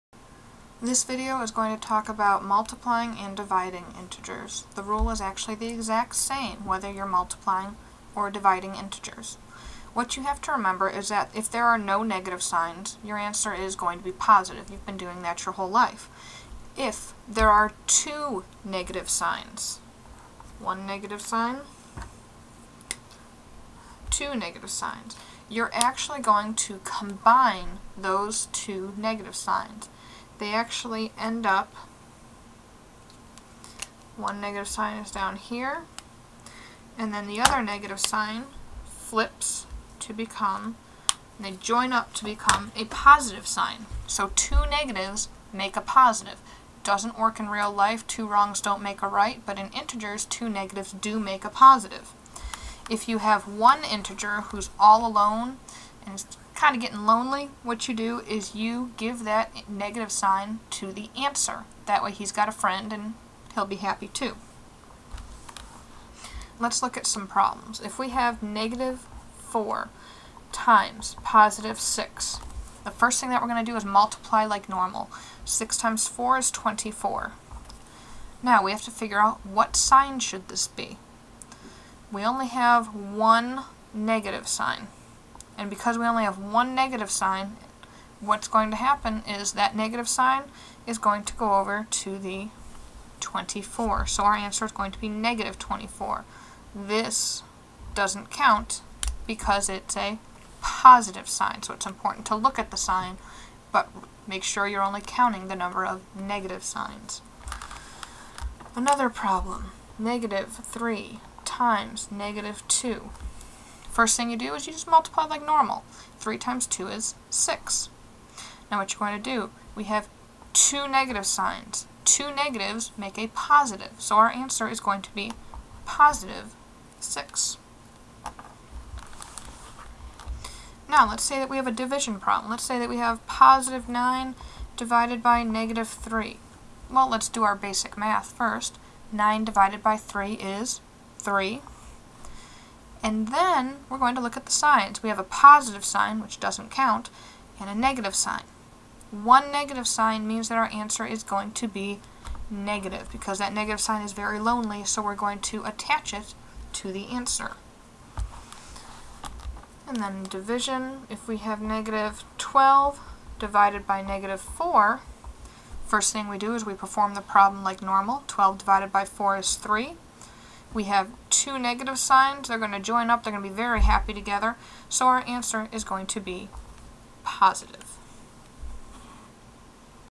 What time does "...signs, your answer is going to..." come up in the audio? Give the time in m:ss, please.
0:12.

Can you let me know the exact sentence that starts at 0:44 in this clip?
So two negatives make a positive.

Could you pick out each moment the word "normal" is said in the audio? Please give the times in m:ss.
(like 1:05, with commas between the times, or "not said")
1:14, 1:55, 2:47.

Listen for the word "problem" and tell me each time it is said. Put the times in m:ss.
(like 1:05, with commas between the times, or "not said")
1:07, 1:49, 2:12, 2:47.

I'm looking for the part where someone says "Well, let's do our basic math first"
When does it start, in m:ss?
2:16.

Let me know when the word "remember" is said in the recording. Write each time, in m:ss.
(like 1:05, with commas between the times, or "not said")
0:10.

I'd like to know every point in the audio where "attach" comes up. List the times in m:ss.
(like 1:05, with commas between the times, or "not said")
2:35.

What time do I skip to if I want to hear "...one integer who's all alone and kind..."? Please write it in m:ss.
0:53.